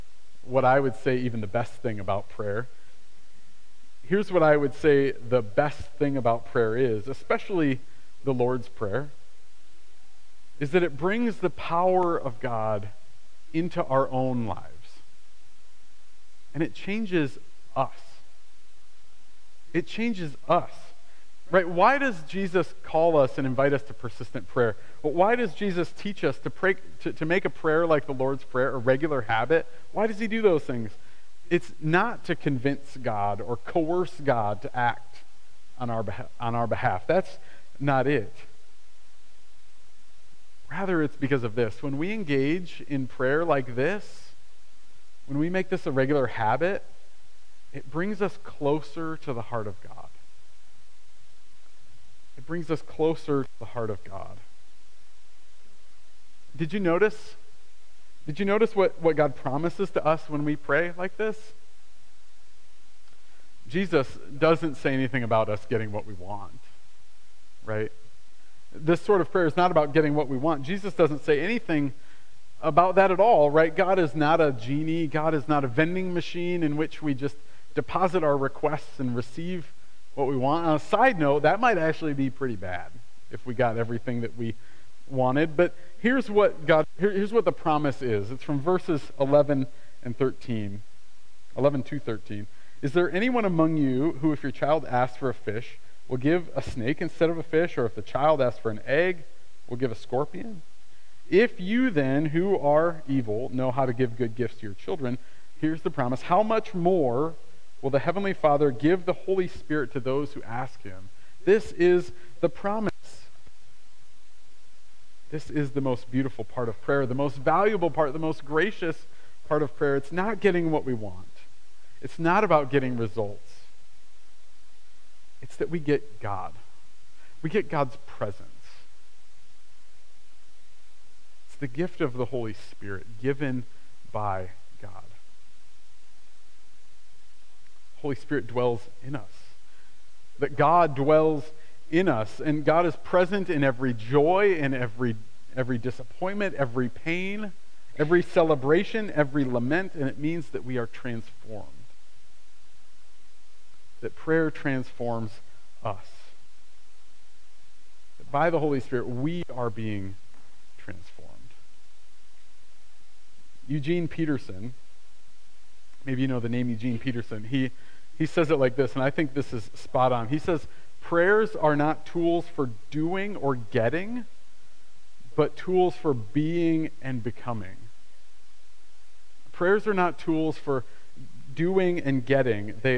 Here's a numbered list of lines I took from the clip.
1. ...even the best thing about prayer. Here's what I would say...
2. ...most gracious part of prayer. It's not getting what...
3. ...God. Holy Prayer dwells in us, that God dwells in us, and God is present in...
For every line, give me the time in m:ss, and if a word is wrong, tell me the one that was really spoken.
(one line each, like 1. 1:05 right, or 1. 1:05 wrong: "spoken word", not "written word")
1. 0:01 right
2. 1:58 right
3. 2:14 wrong: "Spirit", not "Prayer".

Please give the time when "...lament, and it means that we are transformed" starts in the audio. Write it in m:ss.
2:29.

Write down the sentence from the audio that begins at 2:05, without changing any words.
It's that we get God, we get God's presence.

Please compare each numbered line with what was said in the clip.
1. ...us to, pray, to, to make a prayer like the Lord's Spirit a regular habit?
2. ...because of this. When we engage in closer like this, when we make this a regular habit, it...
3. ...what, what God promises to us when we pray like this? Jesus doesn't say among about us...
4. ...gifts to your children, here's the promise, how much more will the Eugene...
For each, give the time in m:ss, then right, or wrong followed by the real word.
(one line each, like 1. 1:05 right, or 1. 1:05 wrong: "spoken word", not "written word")
1. 0:26 wrong: "Prayer", not "Spirit"
2. 0:41 wrong: "prayer", not "closer"
3. 0:58 wrong: "anything", not "among"
4. 1:44 wrong: "Heavenly", not "Eugene".